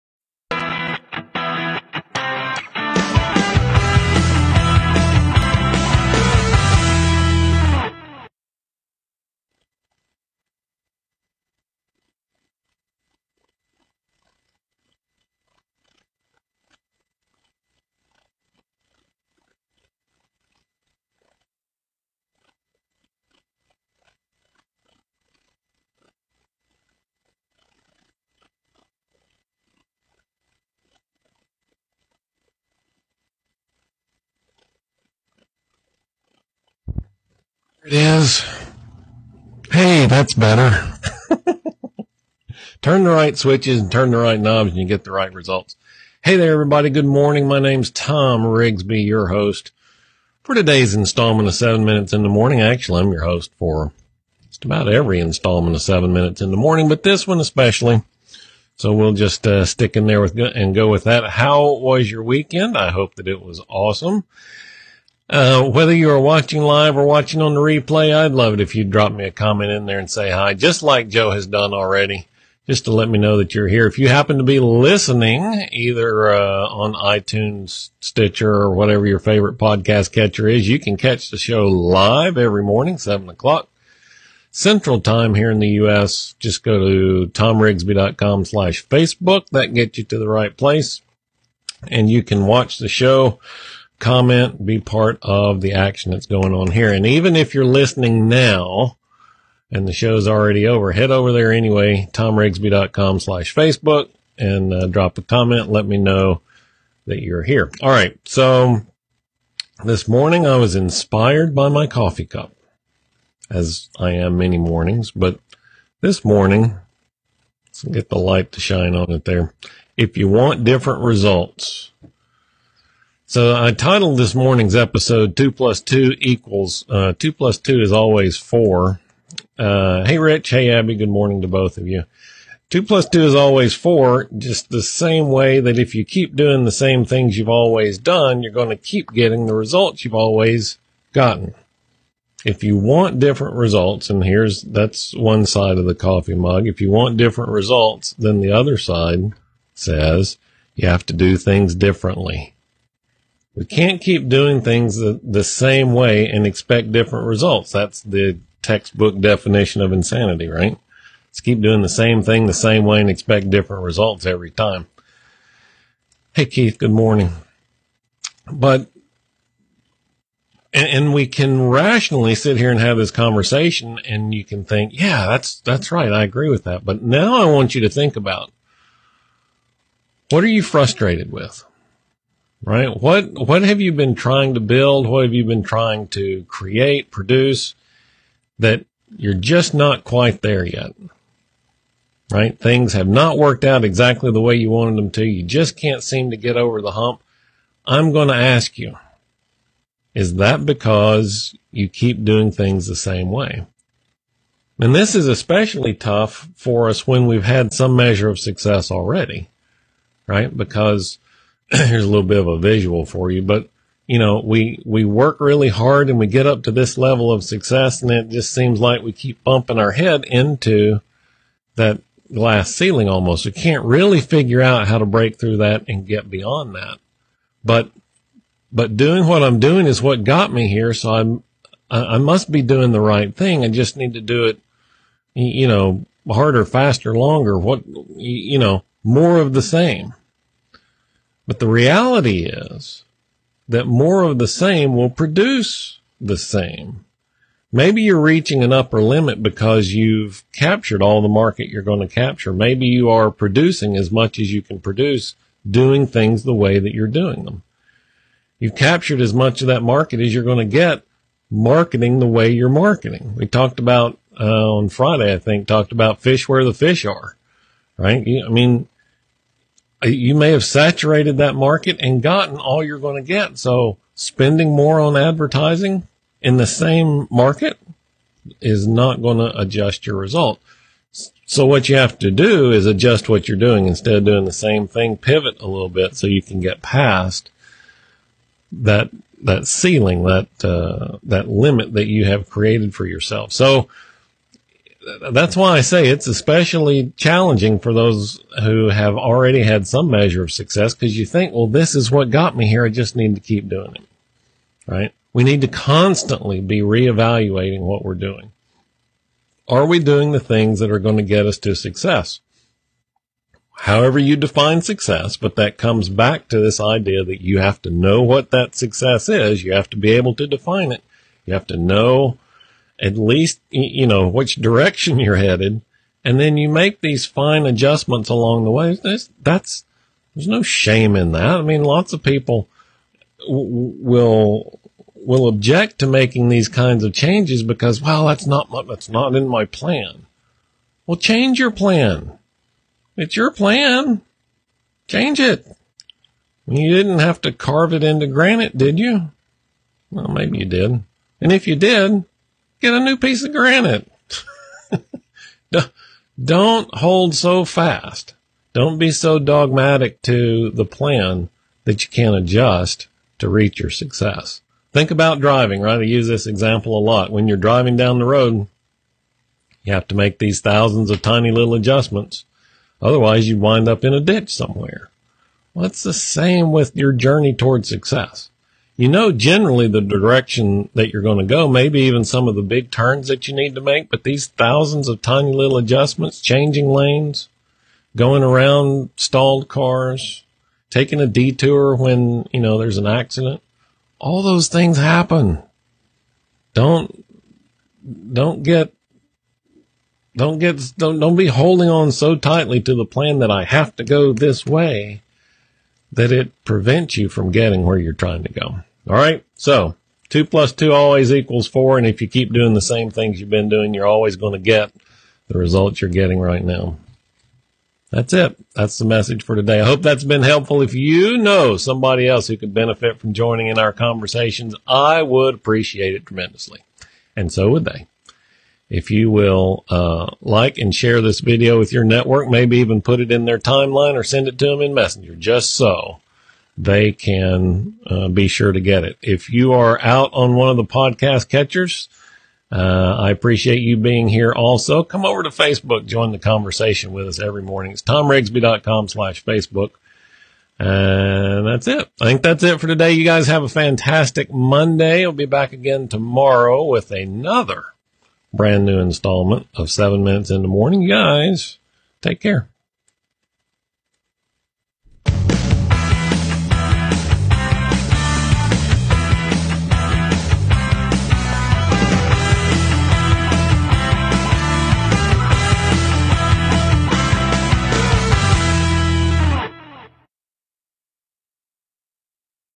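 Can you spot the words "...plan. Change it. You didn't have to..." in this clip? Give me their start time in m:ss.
5:43.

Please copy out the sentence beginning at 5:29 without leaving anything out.
That's, that's there's no shame in that.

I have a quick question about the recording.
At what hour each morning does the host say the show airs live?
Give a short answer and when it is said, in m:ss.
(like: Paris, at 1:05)
7 o'clock, at 1:22.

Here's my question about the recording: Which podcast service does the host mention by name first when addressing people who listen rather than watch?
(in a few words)
iTunes.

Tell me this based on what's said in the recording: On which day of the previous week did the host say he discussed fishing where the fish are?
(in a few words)
Friday.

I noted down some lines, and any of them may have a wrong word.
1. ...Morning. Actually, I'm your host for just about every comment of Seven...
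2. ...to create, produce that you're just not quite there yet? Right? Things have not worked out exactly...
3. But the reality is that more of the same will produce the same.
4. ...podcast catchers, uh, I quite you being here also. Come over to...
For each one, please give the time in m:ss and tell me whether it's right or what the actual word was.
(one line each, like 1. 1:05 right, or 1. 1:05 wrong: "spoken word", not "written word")
1. 0:52 wrong: "installment", not "comment"
2. 3:06 right
3. 4:01 right
4. 7:20 wrong: "appreciate", not "quite".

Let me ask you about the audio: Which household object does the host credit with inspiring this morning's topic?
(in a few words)
coffee cup.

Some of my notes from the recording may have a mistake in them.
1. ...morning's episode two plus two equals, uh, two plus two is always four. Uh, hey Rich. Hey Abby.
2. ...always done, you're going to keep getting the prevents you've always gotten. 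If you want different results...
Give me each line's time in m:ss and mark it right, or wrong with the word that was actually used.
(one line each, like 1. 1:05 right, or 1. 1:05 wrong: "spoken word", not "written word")
1. 2:04 right
2. 2:17 wrong: "results", not "prevents".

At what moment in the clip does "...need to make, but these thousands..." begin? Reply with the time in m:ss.
6:23.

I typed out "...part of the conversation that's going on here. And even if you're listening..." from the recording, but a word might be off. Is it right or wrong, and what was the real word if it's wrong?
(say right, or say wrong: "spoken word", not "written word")
wrong: "action", not "conversation".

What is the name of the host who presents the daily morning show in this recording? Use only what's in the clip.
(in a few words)
Thom Rigsby.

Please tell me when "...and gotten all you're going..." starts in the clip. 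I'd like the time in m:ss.
4:31.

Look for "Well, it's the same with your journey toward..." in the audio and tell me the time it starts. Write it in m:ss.
6:15.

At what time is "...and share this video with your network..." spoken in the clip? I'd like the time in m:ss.
7:10.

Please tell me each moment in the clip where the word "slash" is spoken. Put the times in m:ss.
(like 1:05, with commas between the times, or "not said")
1:28, 1:43, 7:29.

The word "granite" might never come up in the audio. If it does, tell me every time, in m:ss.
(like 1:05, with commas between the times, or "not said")
5:48, 5:53.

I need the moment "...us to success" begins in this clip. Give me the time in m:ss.
5:11.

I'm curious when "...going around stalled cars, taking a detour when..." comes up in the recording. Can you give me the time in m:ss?
6:28.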